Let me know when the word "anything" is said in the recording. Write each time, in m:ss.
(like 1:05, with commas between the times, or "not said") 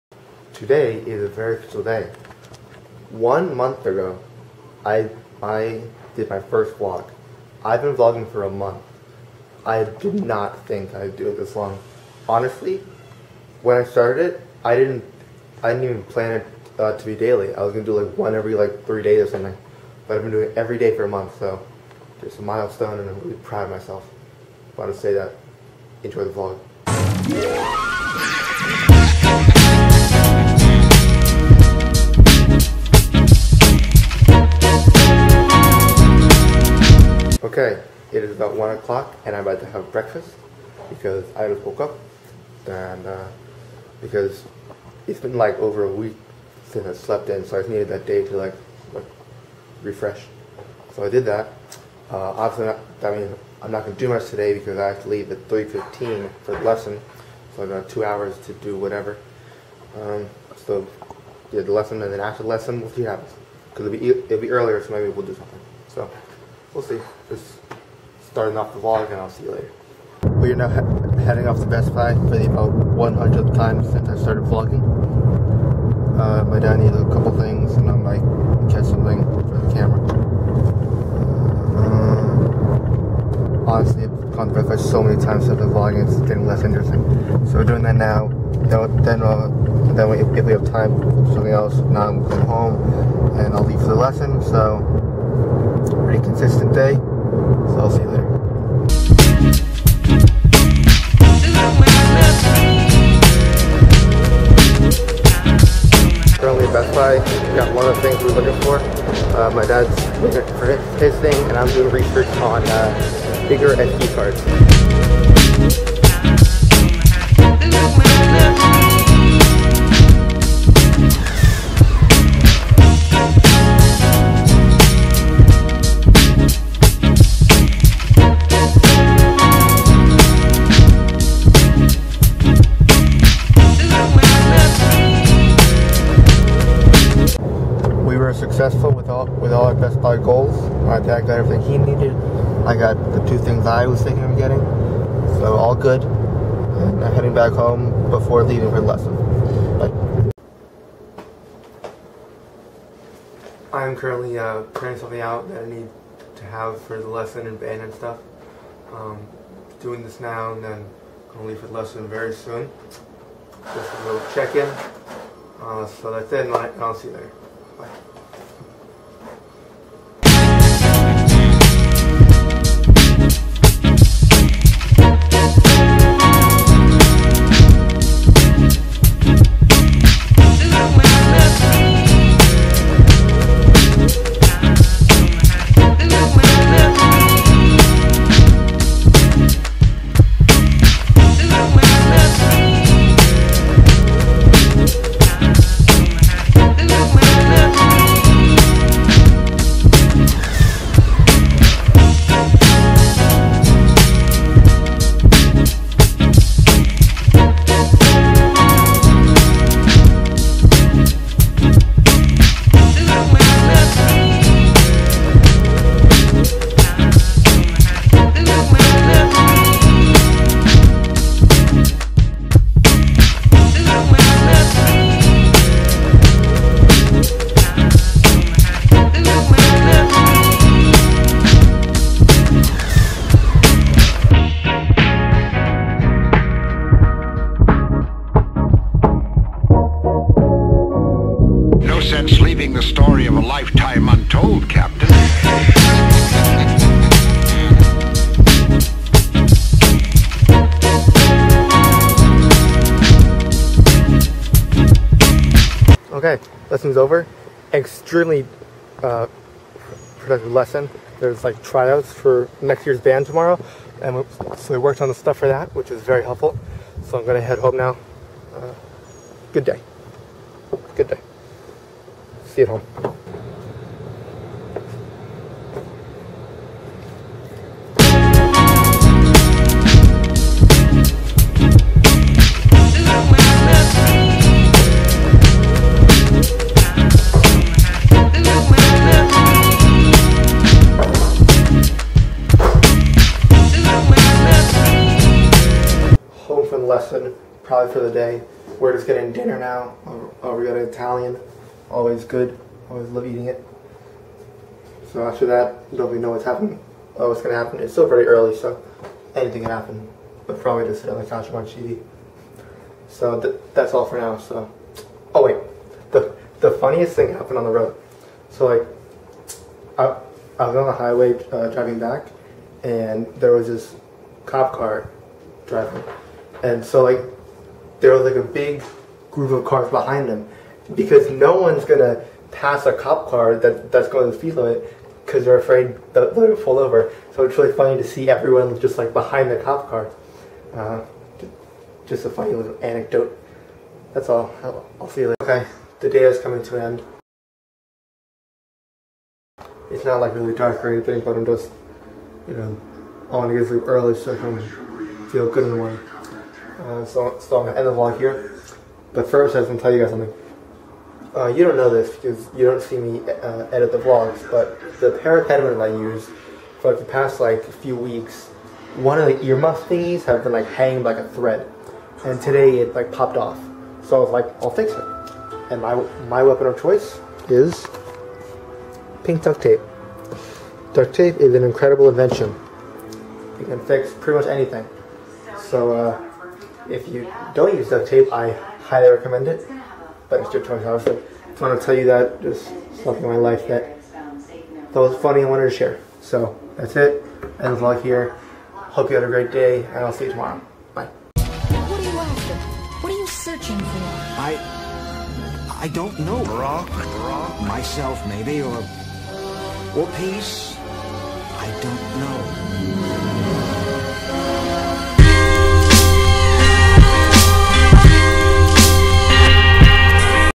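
5:09, 5:50, 6:24.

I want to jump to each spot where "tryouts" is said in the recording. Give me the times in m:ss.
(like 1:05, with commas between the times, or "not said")
4:21.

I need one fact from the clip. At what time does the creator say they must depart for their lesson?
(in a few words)
3:15.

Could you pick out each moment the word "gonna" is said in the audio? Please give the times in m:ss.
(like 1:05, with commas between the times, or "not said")
0:17, 2:41, 4:27, 5:07, 5:31, 5:57.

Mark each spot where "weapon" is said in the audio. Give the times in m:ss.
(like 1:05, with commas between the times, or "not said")
6:16.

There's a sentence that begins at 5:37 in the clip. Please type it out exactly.
So it's really funny to see everyone just like behind the cop car.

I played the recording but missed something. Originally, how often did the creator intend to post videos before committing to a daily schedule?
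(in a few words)
every 3 days.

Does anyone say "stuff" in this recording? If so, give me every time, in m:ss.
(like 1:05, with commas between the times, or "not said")
2:37, 4:25.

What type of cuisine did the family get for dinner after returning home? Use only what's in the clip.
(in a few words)
Italian.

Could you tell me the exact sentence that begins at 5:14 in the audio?
So, oh wait, the the funniest thing happened on the road.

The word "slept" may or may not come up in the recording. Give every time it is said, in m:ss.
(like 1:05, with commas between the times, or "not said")
0:46.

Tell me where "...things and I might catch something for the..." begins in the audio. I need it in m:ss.
1:17.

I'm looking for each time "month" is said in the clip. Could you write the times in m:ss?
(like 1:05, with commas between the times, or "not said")
0:03, 0:08, 0:21.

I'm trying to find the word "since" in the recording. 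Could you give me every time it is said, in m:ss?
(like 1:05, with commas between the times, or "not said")
0:46, 1:13, 1:25.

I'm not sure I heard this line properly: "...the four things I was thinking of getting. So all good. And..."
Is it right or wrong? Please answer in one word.
wrong.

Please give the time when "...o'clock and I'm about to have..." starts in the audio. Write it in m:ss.
0:38.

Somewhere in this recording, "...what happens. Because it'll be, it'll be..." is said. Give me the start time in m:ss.
1:03.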